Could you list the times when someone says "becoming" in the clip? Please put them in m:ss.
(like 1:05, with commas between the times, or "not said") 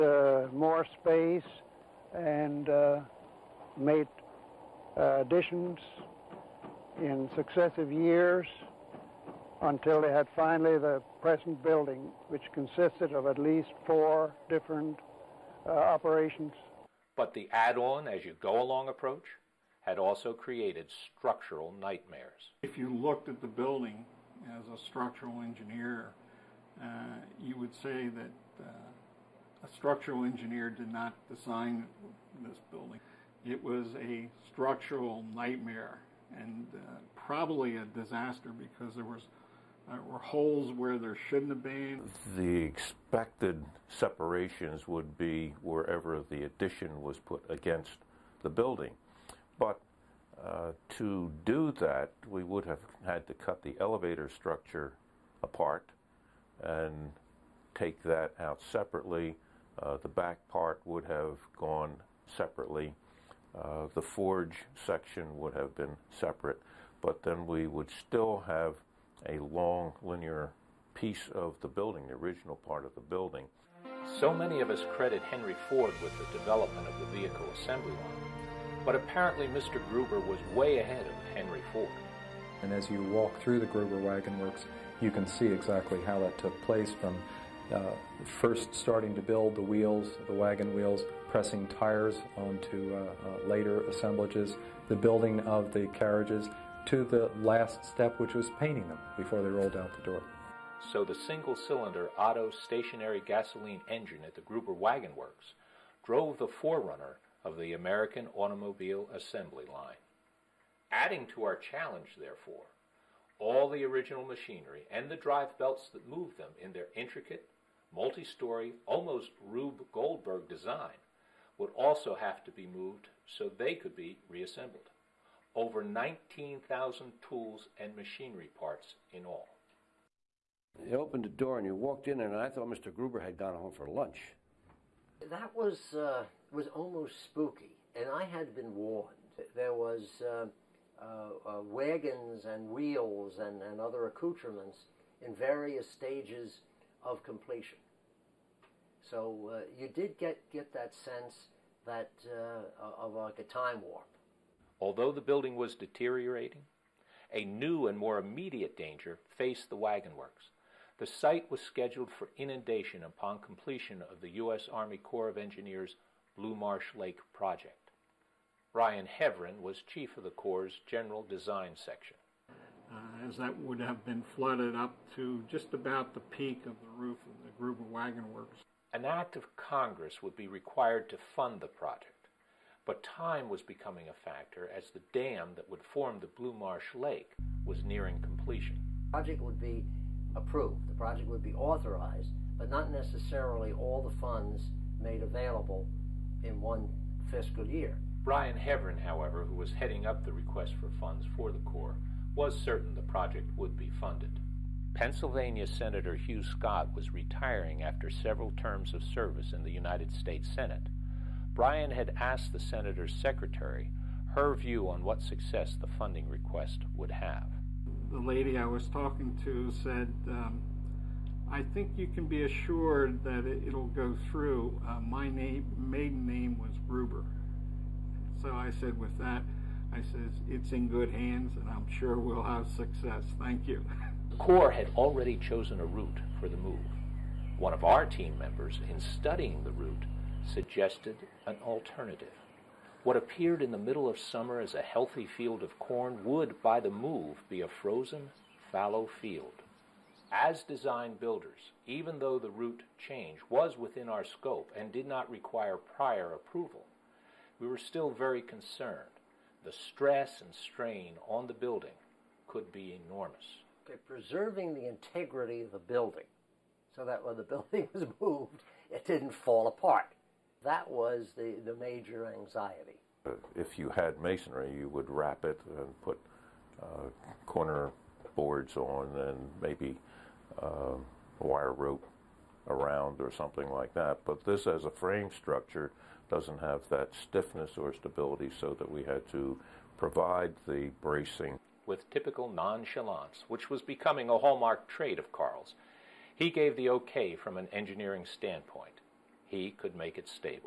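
3:03, 4:53.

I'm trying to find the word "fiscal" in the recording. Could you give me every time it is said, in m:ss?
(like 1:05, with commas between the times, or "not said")
3:17.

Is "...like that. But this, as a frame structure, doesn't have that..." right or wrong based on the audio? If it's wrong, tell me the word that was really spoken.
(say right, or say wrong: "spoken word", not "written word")
right.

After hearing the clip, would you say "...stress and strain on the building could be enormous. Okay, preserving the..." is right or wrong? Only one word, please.
right.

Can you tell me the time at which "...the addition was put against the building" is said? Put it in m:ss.
0:46.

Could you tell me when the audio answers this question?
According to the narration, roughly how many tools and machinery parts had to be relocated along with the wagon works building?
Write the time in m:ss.
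2:05.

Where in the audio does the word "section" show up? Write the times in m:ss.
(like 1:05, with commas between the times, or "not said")
1:04, 2:51.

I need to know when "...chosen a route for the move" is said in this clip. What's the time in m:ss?
3:55.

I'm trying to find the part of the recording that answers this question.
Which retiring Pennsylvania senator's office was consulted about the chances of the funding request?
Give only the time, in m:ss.
3:26.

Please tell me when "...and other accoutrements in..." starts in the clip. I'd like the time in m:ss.
2:23.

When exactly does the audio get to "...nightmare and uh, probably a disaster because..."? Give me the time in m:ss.
0:35.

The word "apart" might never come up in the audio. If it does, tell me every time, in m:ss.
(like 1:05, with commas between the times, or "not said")
0:55, 4:29.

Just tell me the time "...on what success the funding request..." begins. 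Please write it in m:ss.
3:34.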